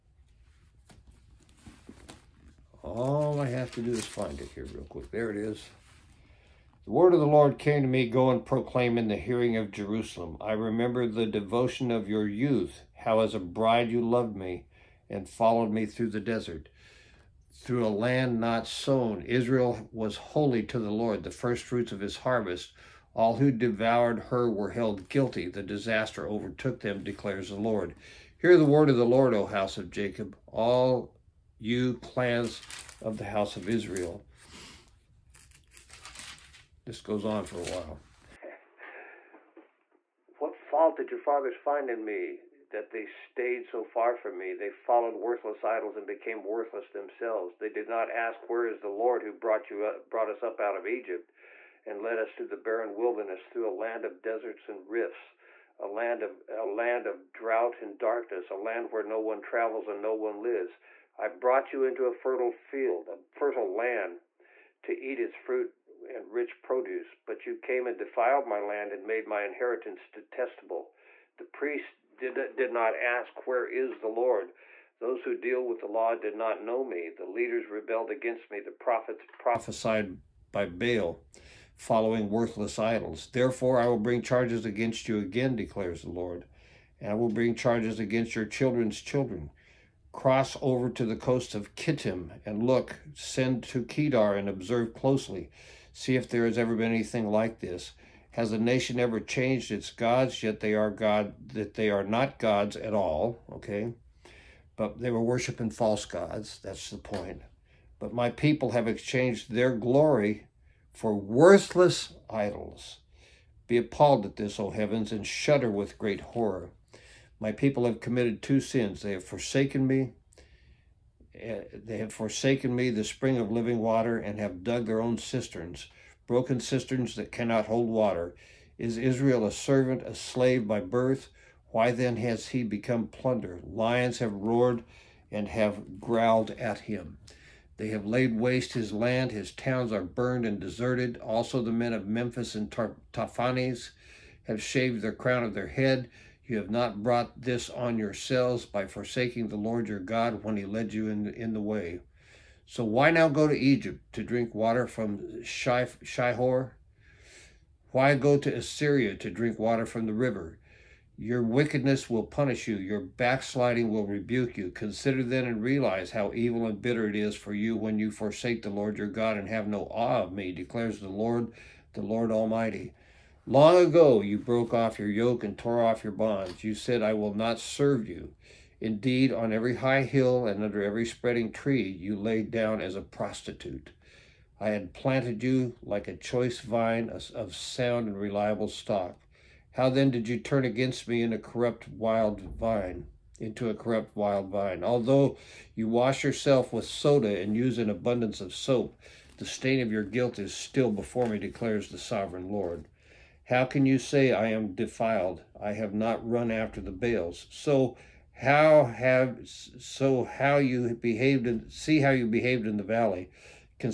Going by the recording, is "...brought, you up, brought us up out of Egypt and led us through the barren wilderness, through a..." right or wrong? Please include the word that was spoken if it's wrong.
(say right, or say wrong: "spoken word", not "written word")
right.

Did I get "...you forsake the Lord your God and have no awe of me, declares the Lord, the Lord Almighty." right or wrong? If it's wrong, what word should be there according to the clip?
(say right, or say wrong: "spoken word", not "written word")
right.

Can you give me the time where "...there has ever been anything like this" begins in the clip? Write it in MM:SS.
01:36.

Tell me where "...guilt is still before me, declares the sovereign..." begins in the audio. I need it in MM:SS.
03:20.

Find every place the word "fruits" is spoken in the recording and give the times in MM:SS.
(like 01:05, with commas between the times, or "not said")
00:21, 01:05.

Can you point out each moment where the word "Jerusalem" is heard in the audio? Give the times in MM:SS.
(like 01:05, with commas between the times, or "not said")
00:09.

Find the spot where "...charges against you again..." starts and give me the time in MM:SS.
01:24.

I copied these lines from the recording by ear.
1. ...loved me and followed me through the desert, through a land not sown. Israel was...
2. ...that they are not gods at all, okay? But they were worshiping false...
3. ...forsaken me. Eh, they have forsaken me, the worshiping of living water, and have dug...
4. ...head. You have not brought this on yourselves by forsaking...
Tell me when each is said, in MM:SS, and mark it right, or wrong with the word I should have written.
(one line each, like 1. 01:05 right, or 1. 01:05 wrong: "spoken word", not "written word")
1. 00:14 right
2. 01:41 right
3. 01:59 wrong: "spring", not "worshiping"
4. 02:25 right.